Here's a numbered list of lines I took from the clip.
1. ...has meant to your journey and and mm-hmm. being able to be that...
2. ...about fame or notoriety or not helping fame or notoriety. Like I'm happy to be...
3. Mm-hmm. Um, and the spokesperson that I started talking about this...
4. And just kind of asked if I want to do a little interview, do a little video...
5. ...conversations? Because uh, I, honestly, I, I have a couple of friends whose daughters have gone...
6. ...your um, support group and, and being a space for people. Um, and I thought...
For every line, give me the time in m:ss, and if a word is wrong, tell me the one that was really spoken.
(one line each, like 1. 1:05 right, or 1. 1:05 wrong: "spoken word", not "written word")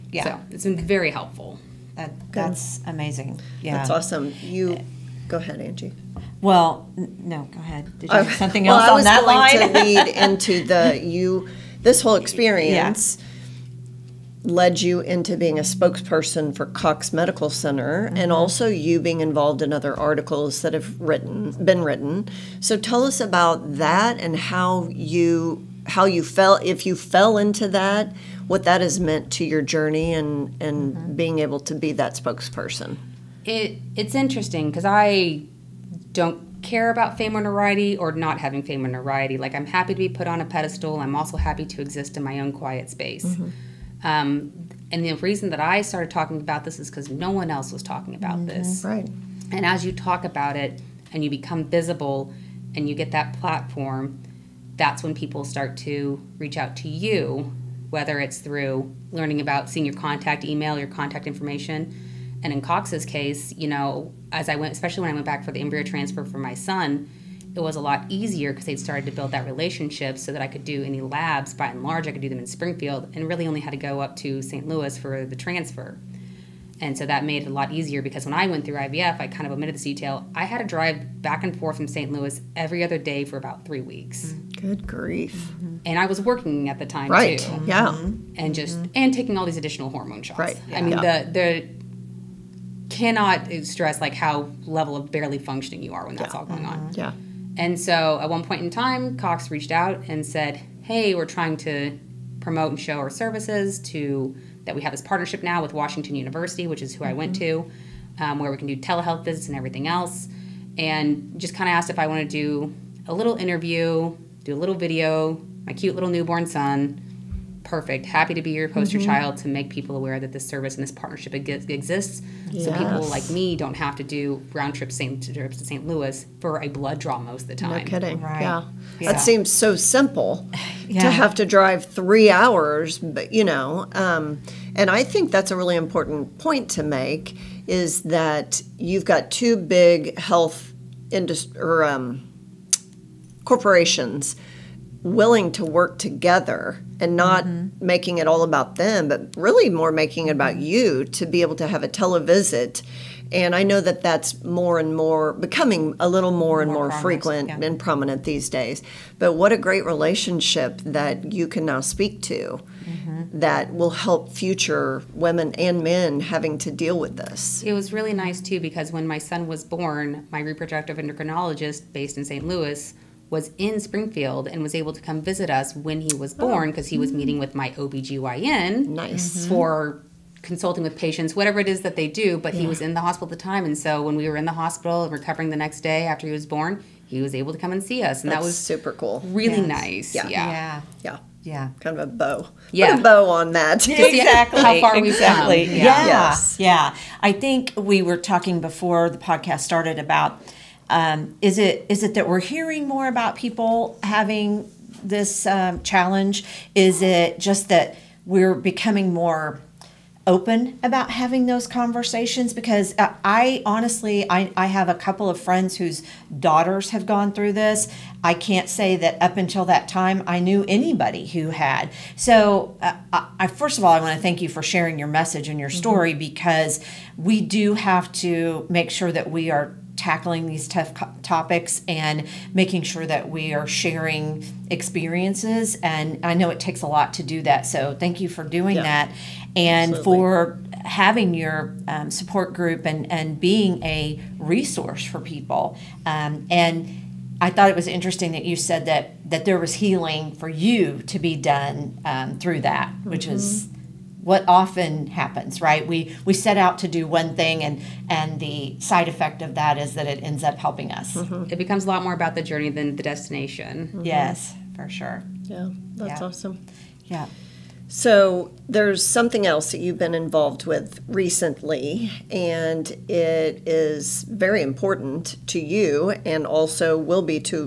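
1. 0:28 right
2. 0:36 wrong: "having", not "helping"
3. 0:43 wrong: "reason", not "spokesperson"
4. 1:50 right
5. 3:31 right
6. 4:01 wrong: "resource", not "space".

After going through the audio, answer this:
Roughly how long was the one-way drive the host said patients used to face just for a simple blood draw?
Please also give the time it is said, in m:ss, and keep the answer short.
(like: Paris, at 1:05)
3 hours, at 2:11.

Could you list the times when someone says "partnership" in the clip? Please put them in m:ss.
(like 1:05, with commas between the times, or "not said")
1:45, 2:00.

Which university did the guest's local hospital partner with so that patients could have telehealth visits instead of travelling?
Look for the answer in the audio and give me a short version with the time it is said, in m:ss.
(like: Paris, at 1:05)
Washington University, at 1:45.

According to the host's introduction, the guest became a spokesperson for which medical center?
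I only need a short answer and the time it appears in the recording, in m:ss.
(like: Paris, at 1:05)
Cox Medical Center, at 0:16.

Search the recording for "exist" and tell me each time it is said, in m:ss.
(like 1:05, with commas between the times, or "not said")
0:41, 2:01.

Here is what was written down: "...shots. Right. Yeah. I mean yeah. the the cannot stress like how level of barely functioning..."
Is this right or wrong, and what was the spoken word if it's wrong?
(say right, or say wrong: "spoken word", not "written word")
right.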